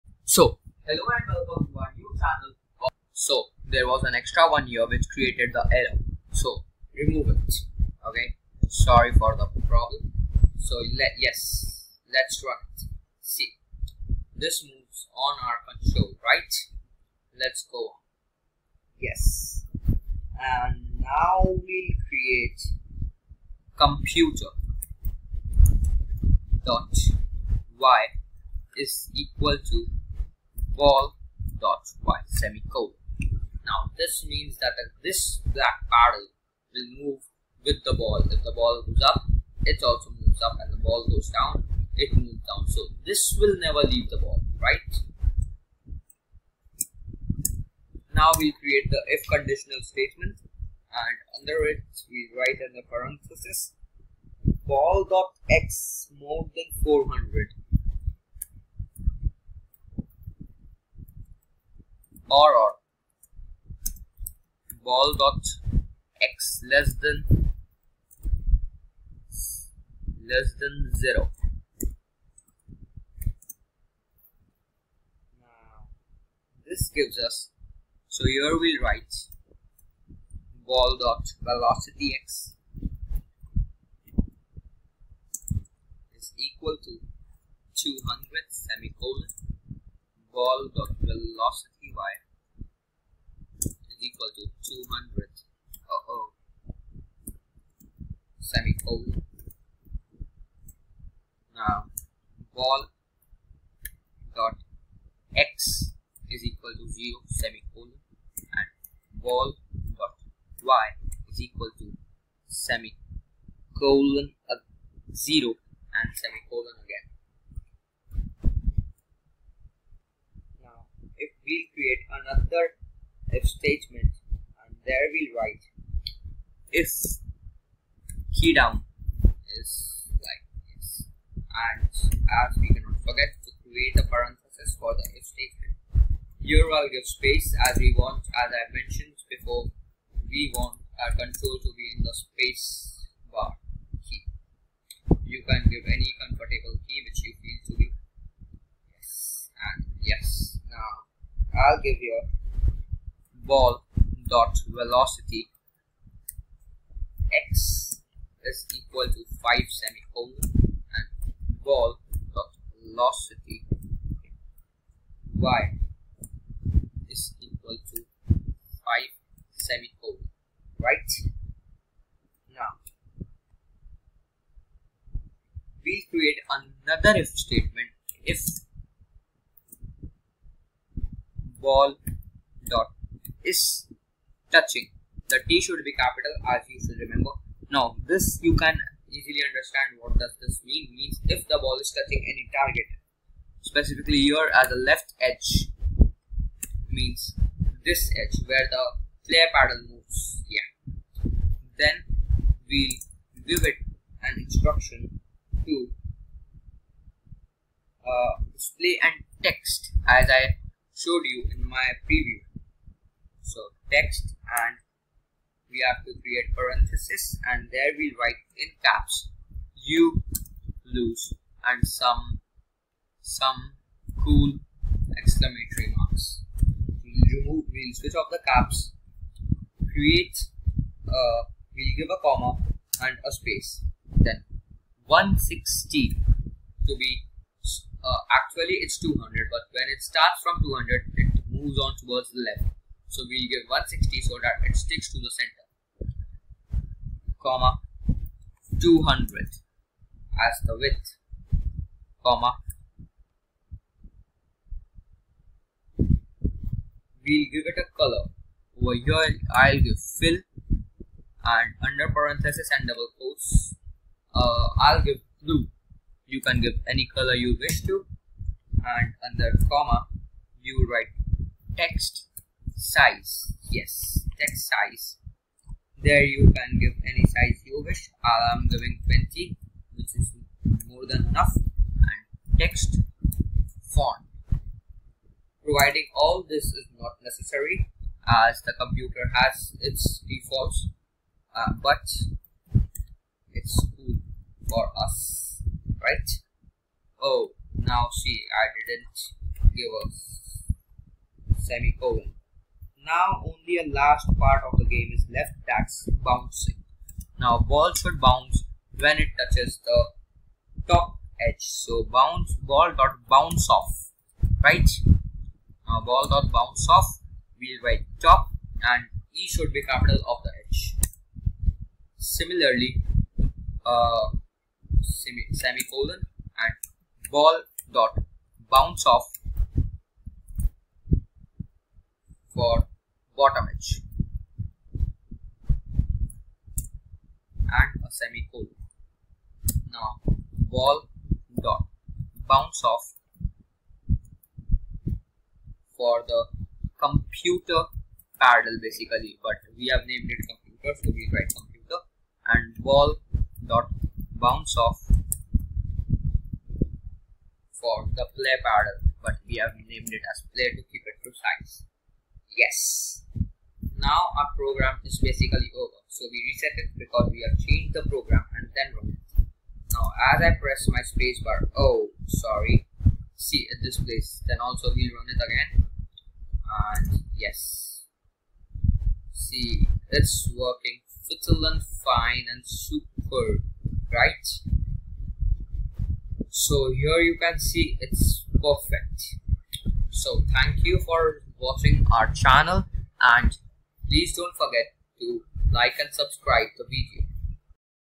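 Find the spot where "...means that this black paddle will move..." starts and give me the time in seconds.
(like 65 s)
34 s.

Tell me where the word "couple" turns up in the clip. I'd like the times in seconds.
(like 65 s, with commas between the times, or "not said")
not said.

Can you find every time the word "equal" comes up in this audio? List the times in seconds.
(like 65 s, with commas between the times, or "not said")
29 s, 86 s, 94 s, 106 s, 111 s, 158 s, 167 s.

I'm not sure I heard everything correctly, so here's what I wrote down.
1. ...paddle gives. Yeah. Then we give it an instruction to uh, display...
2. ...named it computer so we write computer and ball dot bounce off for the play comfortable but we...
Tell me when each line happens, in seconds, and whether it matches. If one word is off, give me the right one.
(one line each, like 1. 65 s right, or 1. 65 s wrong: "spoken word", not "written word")
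1. 199 s wrong: "moves", not "gives"
2. 350 s wrong: "paddle", not "comfortable".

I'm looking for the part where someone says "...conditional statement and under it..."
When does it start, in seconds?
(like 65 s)
49 s.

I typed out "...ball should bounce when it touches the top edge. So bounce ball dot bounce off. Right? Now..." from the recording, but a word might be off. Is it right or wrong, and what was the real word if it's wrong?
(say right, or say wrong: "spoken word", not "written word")
right.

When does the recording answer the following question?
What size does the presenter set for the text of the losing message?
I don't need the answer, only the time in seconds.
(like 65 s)
279 s.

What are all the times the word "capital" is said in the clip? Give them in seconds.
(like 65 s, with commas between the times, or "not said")
185 s, 319 s.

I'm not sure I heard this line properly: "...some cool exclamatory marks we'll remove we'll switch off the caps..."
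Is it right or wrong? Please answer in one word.
right.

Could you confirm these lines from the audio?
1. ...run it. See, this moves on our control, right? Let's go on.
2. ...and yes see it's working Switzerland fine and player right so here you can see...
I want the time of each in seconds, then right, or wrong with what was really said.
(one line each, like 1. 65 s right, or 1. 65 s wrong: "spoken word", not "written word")
1. 12 s right
2. 376 s wrong: "super", not "player".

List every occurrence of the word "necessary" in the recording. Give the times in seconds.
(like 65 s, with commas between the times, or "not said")
287 s.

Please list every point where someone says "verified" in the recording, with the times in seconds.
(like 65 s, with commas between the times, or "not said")
not said.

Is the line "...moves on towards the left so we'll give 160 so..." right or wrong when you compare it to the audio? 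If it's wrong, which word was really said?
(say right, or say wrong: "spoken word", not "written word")
right.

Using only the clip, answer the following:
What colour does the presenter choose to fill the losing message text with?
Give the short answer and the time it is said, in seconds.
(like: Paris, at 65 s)
blue, at 265 s.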